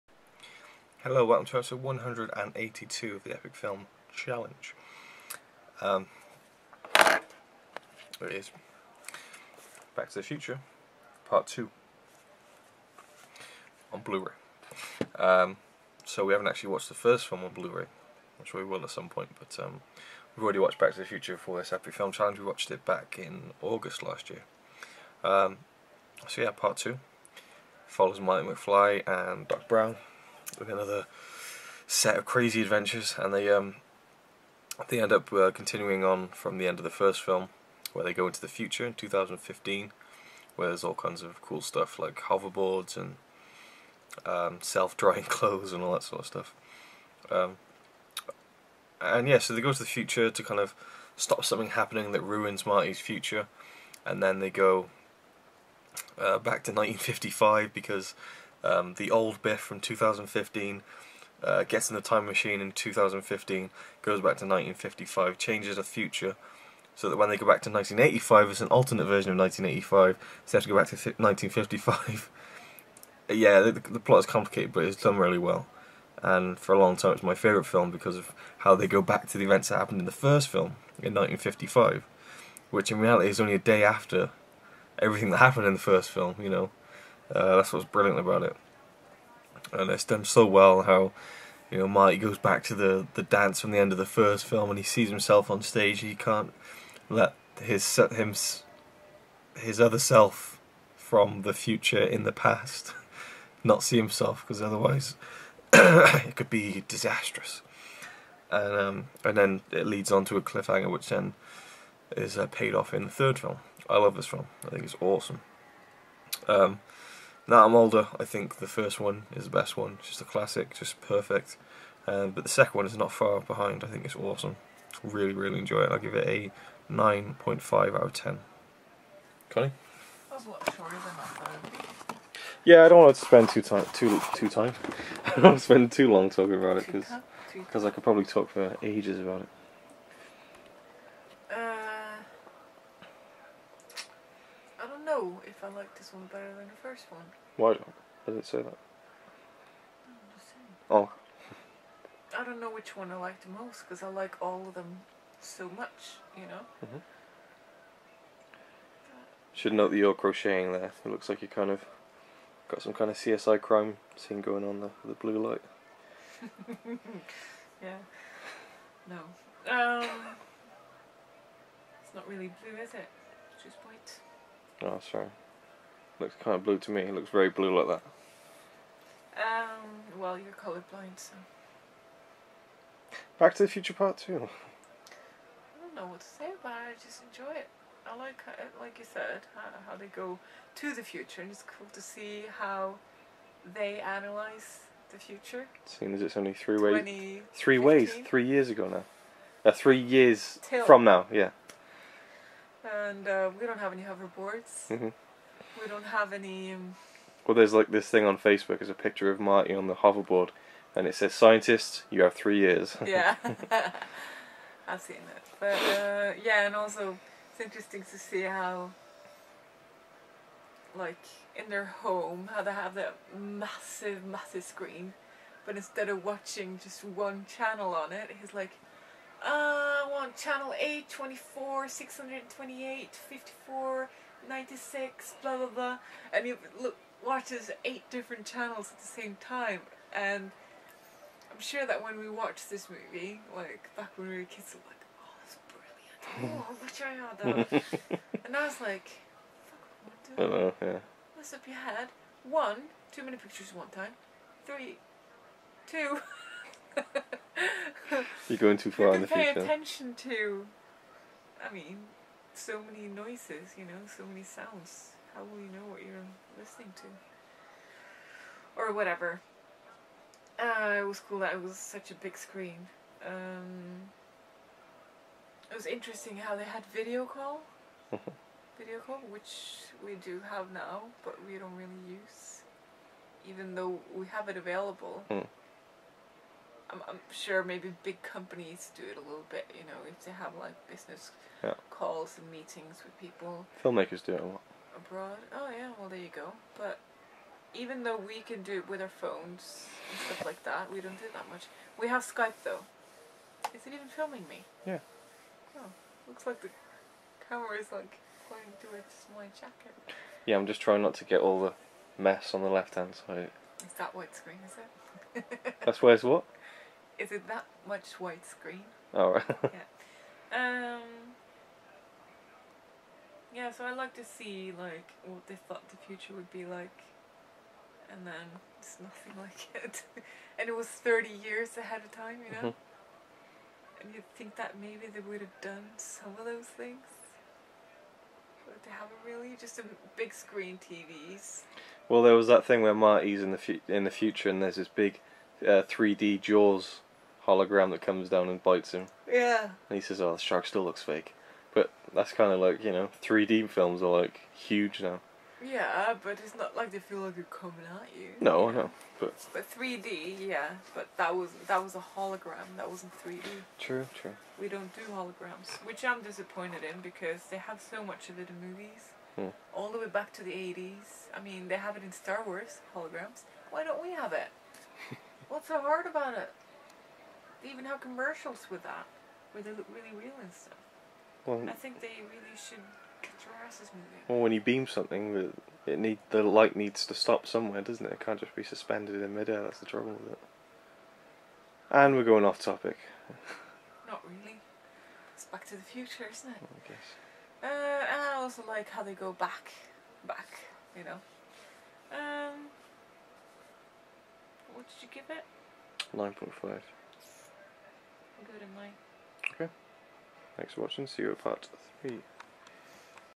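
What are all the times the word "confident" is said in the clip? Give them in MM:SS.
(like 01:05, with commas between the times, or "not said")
not said.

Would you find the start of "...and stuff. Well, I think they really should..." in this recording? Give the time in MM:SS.
06:20.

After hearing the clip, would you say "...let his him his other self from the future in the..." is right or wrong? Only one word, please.
right.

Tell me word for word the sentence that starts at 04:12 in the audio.
One, too many pictures at one time.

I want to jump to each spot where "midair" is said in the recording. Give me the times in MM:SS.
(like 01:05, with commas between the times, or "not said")
06:29.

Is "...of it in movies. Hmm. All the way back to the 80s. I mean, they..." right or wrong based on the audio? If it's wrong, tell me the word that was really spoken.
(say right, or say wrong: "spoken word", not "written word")
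right.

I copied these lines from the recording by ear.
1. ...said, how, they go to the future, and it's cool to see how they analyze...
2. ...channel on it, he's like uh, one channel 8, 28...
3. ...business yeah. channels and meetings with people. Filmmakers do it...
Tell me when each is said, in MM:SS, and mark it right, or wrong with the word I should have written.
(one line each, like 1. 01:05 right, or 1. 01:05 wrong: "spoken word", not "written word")
1. 03:09 right
2. 03:47 wrong: "24", not "28"
3. 04:50 wrong: "calls", not "channels".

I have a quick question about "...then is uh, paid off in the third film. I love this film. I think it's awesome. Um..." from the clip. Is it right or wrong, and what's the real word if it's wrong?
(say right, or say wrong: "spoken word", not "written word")
right.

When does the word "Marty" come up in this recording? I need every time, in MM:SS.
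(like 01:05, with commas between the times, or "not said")
00:28, 00:52, 01:31, 03:29, 05:42.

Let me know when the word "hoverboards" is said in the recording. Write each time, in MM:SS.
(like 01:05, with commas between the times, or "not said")
00:42, 03:24, 03:29.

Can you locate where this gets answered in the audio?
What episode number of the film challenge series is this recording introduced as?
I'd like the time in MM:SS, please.
00:01.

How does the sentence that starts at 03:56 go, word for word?
And you look, watches eight different channels at the same time.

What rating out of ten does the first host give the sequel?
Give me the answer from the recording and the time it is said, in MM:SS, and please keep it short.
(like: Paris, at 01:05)
9.5, at 02:06.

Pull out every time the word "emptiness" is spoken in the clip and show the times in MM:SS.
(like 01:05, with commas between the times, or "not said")
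not said.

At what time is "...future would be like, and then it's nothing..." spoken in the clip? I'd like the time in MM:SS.
05:25.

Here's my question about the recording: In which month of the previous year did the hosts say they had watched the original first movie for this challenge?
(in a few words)
August.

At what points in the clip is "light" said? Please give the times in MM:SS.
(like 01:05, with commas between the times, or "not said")
02:45, 06:26.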